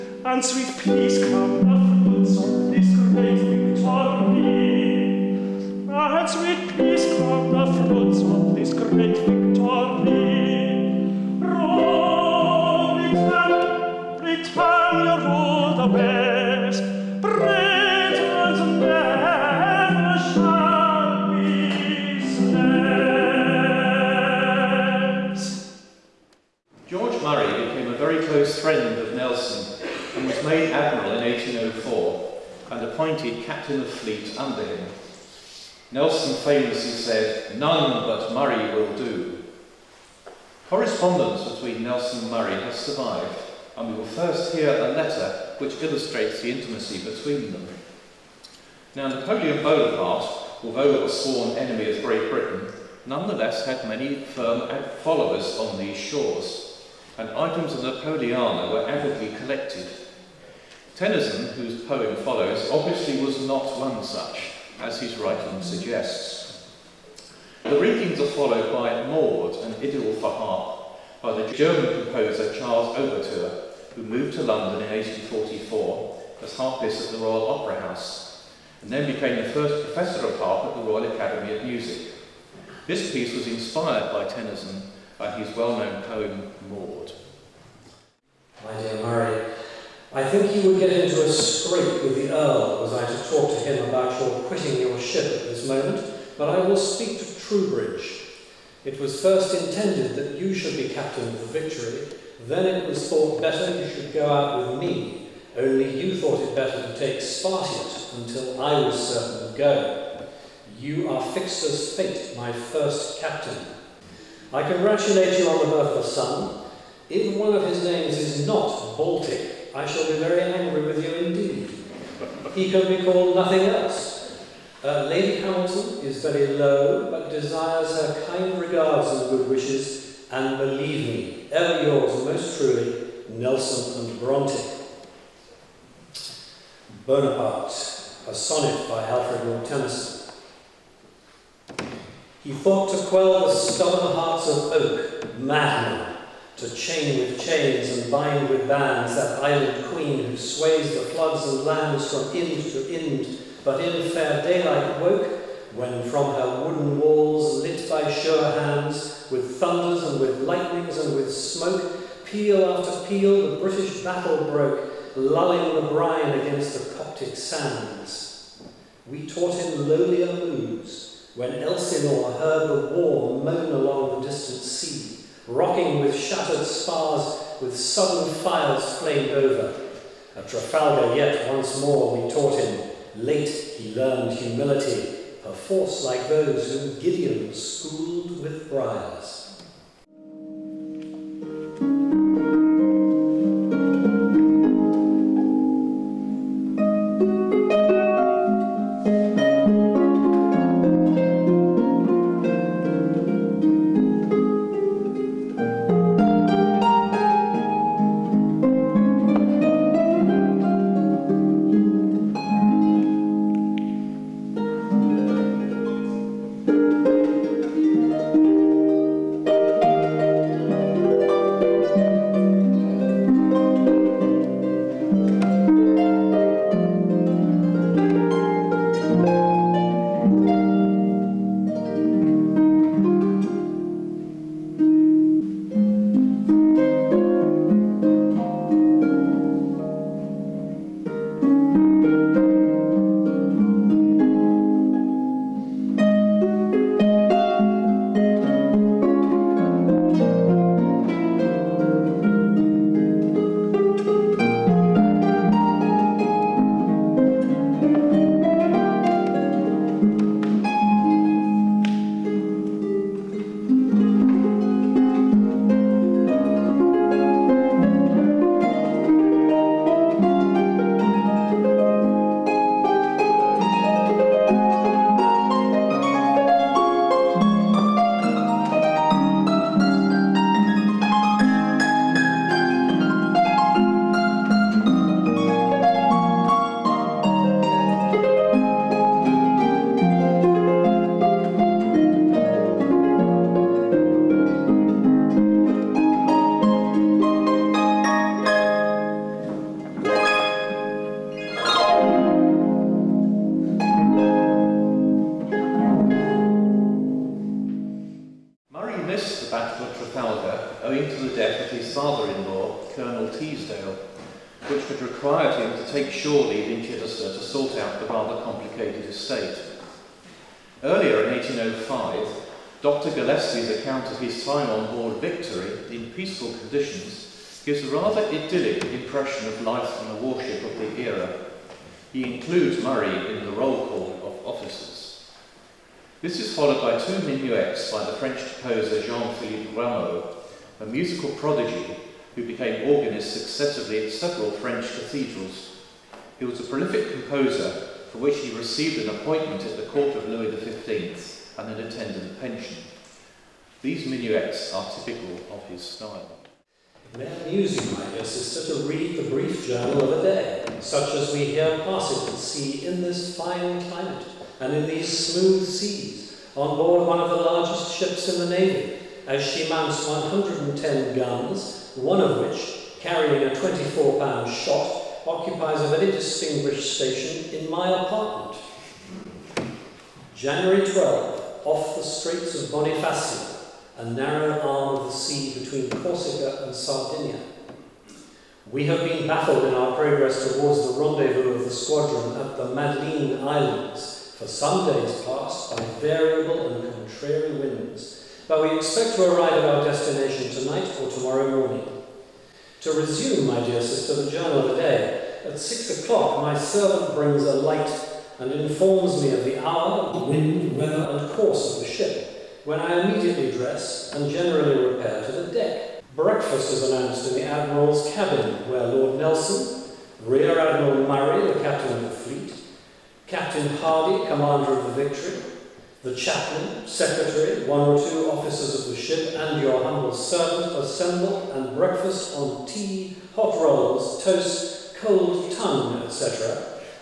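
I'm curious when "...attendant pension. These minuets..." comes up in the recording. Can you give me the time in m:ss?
5:51.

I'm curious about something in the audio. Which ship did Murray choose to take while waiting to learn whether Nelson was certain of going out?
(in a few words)
Spartiate.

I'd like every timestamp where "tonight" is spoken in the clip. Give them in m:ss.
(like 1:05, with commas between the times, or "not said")
6:40.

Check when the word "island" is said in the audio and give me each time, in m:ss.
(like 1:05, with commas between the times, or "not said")
2:29, 6:33.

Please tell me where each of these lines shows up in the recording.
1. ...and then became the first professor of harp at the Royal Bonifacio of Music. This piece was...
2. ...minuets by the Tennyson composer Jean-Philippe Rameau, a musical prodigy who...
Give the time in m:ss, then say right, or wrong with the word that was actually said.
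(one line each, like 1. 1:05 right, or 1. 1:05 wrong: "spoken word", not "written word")
1. 1:18 wrong: "Academy", not "Bonifacio"
2. 5:37 wrong: "French", not "Tennyson".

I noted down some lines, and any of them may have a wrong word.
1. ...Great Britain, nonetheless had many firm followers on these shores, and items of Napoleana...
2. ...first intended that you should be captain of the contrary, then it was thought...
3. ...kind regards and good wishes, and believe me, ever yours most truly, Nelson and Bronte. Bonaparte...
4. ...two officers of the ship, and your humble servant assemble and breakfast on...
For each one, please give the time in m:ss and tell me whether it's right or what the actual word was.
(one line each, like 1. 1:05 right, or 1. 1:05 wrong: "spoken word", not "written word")
1. 0:52 right
2. 1:39 wrong: "victory", not "contrary"
3. 2:08 right
4. 7:07 right.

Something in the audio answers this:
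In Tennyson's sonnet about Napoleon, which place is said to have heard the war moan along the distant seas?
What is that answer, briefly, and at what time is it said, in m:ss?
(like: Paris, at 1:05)
Elsinore, at 2:51.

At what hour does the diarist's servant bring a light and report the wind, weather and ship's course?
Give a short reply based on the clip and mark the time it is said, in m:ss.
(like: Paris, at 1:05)
6 o'clock, at 6:45.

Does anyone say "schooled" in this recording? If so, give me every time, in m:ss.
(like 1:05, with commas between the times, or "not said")
3:07.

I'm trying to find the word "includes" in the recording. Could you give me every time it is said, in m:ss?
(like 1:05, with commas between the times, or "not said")
5:32.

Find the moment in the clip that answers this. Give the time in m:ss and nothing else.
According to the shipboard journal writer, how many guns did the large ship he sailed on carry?
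6:10.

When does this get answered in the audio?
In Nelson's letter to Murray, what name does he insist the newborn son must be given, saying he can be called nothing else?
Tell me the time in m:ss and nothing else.
1:58.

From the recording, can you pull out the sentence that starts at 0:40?
Correspondence between Nelson and Murray has survived, and we will first hear a letter which illustrates the intimacy between them.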